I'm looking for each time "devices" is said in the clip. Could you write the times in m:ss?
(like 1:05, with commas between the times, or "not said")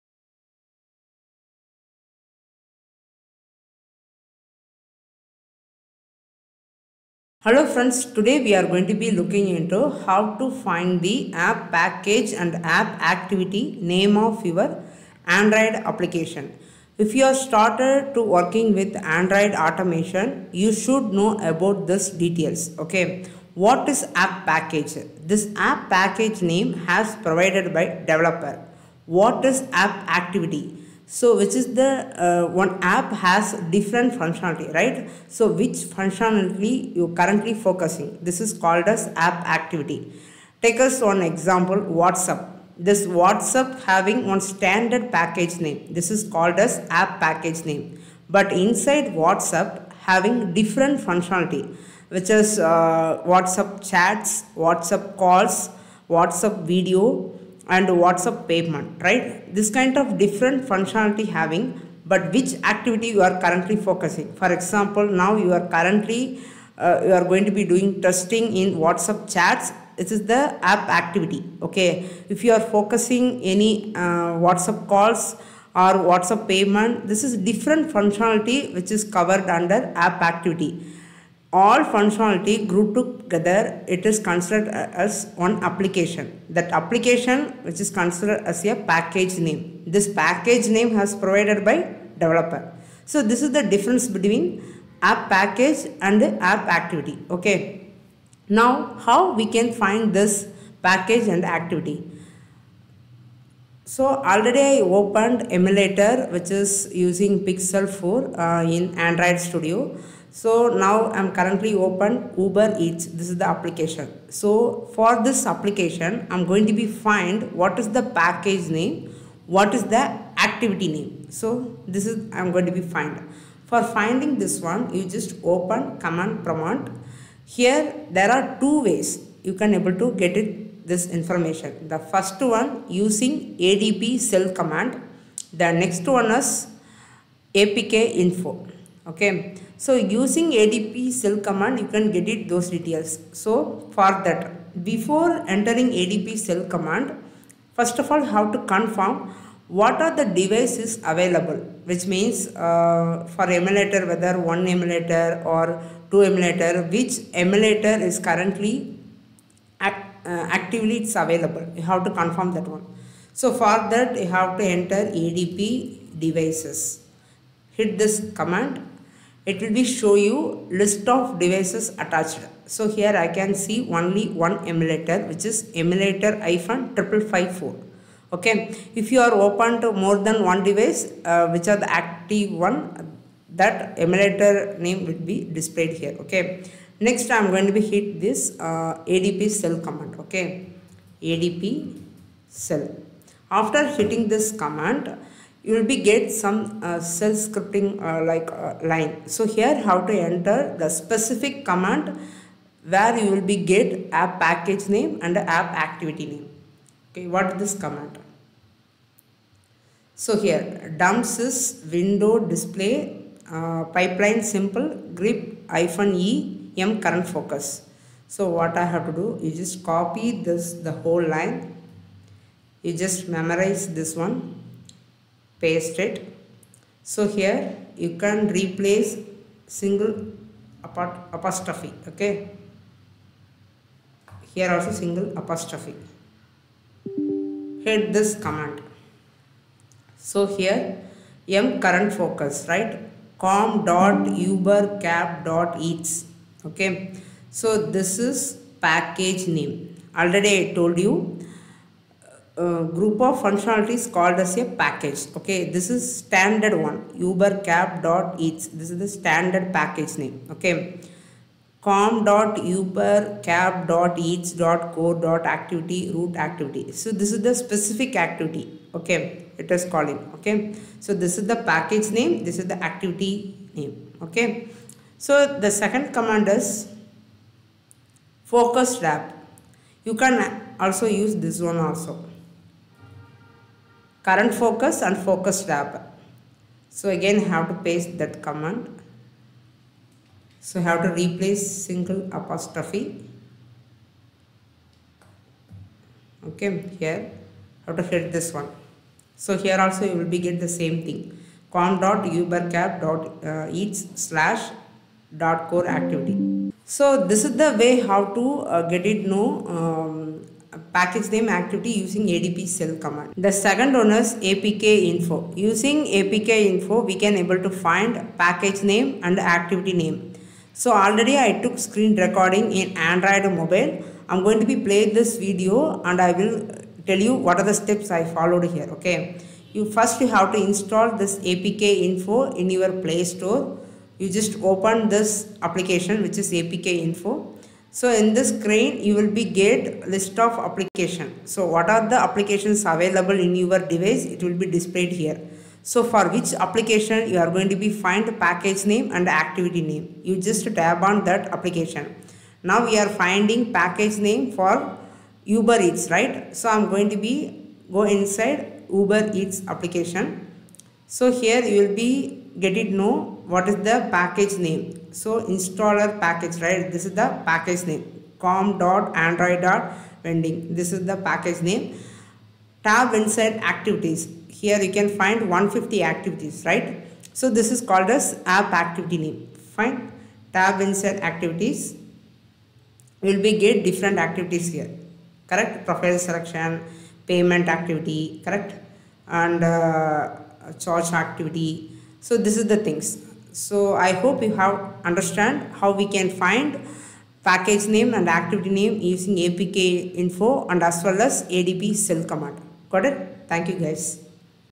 2:30, 2:46, 2:51, 3:00, 5:43.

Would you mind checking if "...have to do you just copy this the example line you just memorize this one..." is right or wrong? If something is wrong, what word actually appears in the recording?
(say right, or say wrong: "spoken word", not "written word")
wrong: "whole", not "example".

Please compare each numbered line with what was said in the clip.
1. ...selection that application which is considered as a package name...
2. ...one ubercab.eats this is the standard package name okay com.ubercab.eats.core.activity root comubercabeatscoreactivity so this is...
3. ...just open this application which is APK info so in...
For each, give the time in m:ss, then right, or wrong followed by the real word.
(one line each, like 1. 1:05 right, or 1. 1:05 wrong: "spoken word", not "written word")
1. 1:25 wrong: "application", not "selection"
2. 4:16 wrong: "activity", not "comubercabeatscoreactivity"
3. 5:34 right.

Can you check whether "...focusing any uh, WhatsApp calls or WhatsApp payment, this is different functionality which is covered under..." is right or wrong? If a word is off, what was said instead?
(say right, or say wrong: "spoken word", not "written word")
right.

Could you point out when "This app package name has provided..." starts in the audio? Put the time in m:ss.
0:25.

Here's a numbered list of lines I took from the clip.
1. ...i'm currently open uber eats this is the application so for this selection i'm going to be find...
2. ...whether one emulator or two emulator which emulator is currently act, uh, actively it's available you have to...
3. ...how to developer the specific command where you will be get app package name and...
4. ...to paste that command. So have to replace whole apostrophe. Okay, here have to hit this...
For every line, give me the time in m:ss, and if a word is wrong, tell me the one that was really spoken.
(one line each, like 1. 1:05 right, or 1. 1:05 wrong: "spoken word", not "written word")
1. 1:51 wrong: "application", not "selection"
2. 2:34 right
3. 3:19 wrong: "enter", not "developer"
4. 4:47 wrong: "single", not "whole".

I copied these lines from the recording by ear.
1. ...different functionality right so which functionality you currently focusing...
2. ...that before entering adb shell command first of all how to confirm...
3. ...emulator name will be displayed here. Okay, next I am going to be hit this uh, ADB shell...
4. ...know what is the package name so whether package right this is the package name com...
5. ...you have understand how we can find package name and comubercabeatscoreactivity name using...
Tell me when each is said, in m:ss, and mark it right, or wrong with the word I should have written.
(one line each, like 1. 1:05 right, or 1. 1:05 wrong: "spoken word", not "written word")
1. 0:33 right
2. 2:24 right
3. 3:03 right
4. 6:02 wrong: "installer", not "whether"
5. 6:34 wrong: "activity", not "comubercabeatscoreactivity".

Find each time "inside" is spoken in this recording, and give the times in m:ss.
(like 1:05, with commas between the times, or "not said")
0:48, 5:58, 6:13, 6:20.